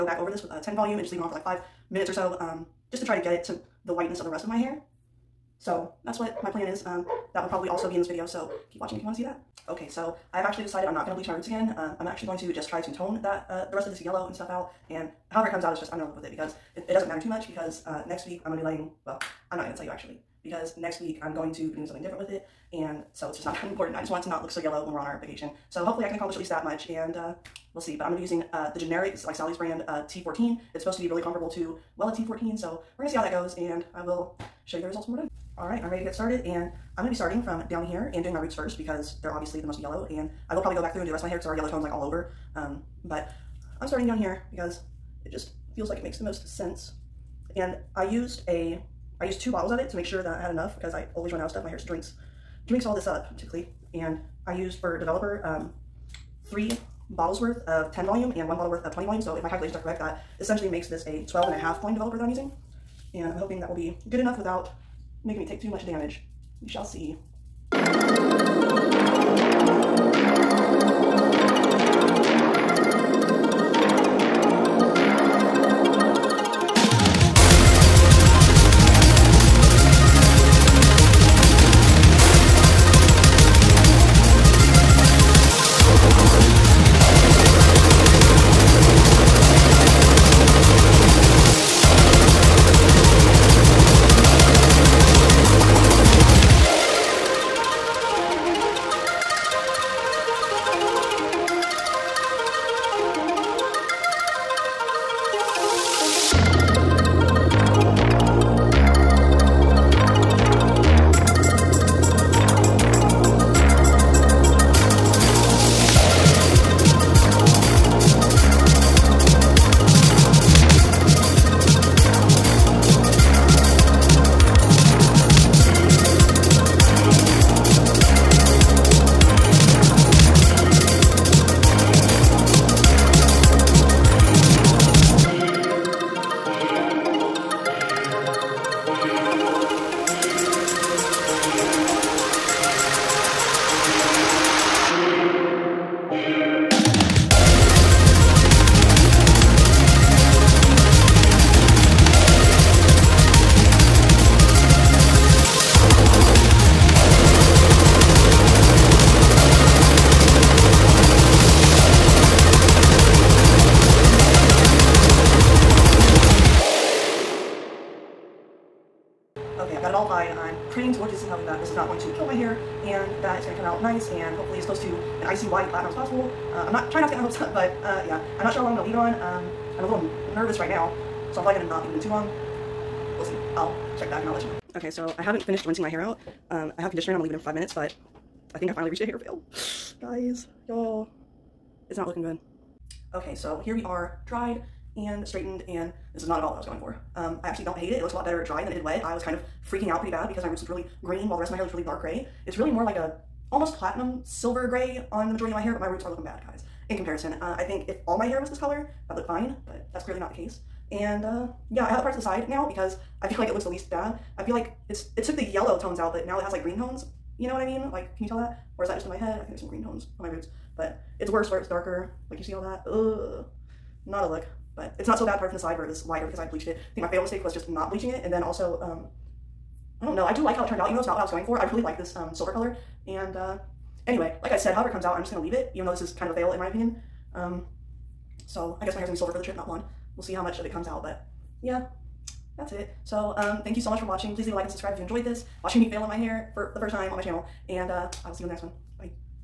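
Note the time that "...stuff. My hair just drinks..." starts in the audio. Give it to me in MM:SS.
00:51.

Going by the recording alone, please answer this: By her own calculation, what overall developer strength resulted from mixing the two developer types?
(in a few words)
12.5 volume.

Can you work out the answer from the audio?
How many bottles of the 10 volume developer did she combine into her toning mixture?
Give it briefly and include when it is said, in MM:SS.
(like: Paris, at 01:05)
3, at 00:56.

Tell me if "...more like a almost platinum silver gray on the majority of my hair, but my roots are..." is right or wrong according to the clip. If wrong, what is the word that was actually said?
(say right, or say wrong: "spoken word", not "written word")
right.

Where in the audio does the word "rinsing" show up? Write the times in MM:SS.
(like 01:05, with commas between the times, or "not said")
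03:05.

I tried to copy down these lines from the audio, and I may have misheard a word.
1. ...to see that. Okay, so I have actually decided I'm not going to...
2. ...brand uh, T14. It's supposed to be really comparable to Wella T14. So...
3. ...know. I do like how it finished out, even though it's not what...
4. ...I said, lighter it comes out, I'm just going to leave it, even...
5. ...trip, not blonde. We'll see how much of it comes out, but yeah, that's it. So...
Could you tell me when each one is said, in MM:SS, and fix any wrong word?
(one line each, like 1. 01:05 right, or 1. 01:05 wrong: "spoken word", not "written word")
1. 00:09 right
2. 00:29 right
3. 03:50 wrong: "turned", not "finished"
4. 03:54 wrong: "however", not "lighter"
5. 03:59 right.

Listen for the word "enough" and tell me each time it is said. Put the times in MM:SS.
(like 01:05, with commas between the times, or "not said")
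00:50, 01:04.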